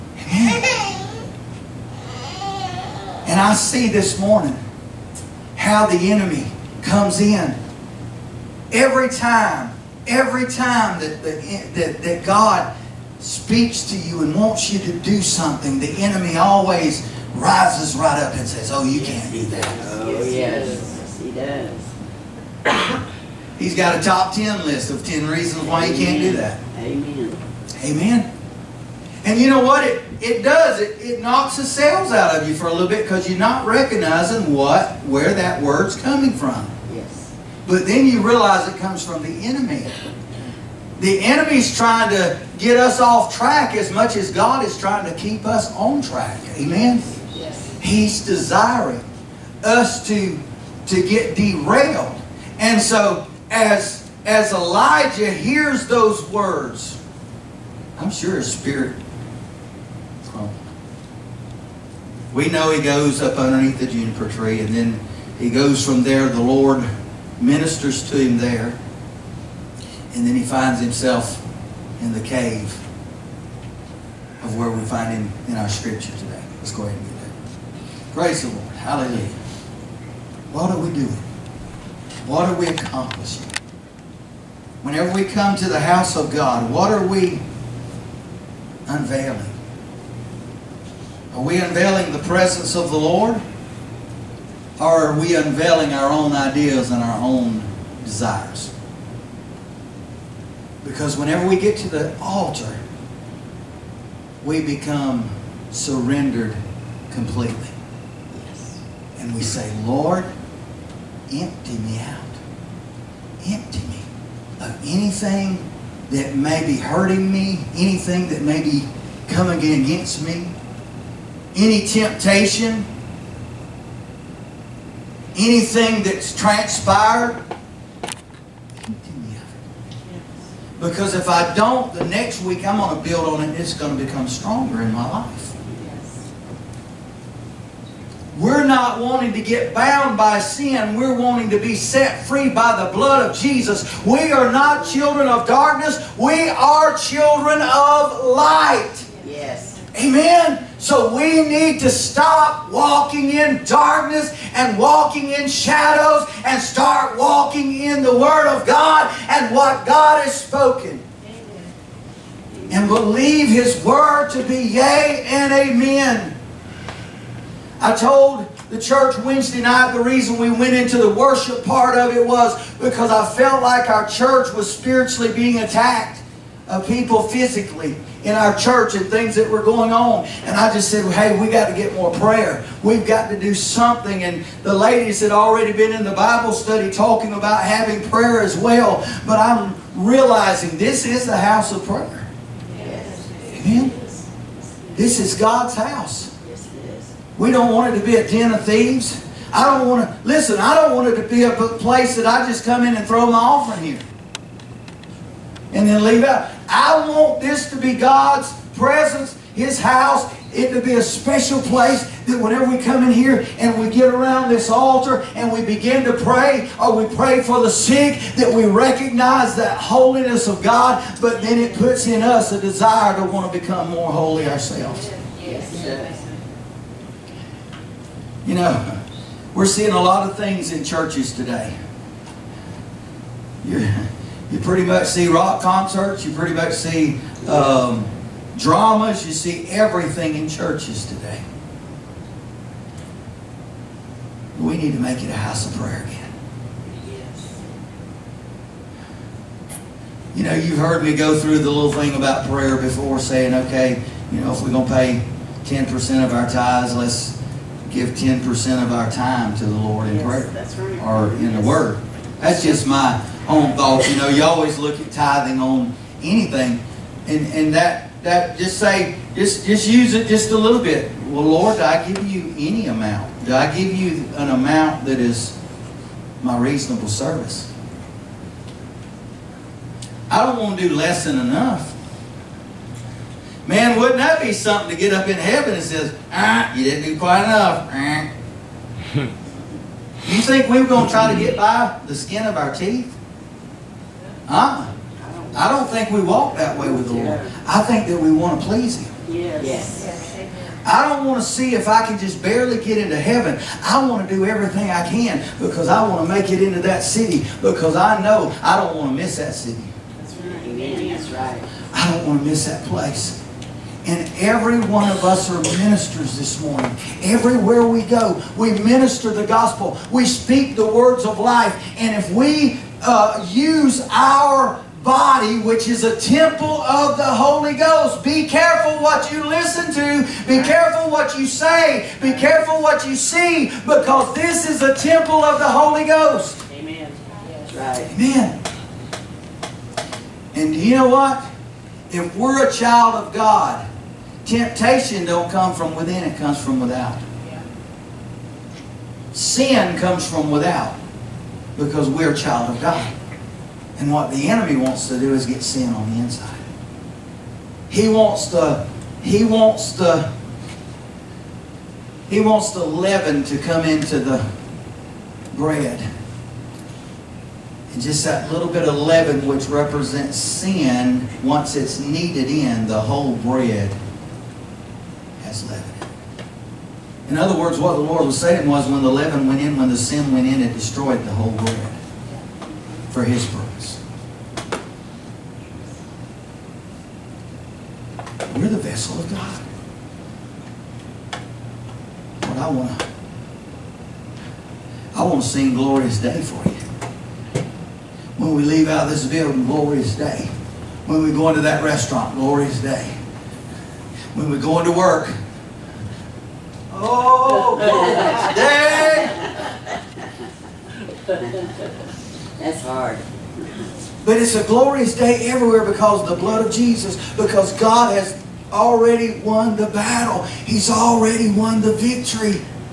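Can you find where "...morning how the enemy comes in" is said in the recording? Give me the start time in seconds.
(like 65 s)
4 s.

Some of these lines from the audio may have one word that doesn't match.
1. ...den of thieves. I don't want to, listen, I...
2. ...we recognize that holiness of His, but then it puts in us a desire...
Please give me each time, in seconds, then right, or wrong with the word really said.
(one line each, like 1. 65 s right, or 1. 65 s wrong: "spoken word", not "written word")
1. 198 s right
2. 218 s wrong: "God", not "His".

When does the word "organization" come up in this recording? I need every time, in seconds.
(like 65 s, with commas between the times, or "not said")
not said.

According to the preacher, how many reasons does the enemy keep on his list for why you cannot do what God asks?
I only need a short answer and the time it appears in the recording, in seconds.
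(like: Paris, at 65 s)
10, at 24 s.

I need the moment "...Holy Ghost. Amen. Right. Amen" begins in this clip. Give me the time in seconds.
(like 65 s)
335 s.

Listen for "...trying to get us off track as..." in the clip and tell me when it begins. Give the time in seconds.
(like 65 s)
41 s.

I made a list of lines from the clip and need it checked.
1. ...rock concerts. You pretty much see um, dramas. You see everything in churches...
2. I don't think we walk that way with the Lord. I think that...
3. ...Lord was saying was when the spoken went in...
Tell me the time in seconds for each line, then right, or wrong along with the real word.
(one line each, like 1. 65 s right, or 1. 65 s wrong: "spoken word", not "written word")
1. 235 s right
2. 295 s right
3. 377 s wrong: "leaven", not "spoken".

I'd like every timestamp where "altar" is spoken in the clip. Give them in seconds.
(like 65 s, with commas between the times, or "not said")
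102 s, 214 s.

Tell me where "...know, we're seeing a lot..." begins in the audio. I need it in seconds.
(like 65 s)
228 s.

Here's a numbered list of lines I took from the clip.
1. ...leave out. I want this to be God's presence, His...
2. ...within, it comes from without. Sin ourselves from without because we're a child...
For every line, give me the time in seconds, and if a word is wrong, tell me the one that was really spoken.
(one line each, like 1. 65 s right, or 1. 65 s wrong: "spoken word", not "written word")
1. 206 s right
2. 345 s wrong: "comes", not "ourselves".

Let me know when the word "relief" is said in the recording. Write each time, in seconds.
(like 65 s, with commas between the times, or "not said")
not said.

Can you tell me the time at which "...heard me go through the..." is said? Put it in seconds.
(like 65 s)
250 s.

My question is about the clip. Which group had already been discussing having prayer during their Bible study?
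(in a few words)
The ladies.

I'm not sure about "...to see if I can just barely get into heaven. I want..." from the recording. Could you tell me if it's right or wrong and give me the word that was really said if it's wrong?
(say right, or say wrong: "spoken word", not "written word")
right.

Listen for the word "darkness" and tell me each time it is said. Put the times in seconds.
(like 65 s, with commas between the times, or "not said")
145 s, 153 s.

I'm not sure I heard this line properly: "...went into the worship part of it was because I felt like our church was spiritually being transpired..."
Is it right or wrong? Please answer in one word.
wrong.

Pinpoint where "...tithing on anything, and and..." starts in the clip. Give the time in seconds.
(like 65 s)
265 s.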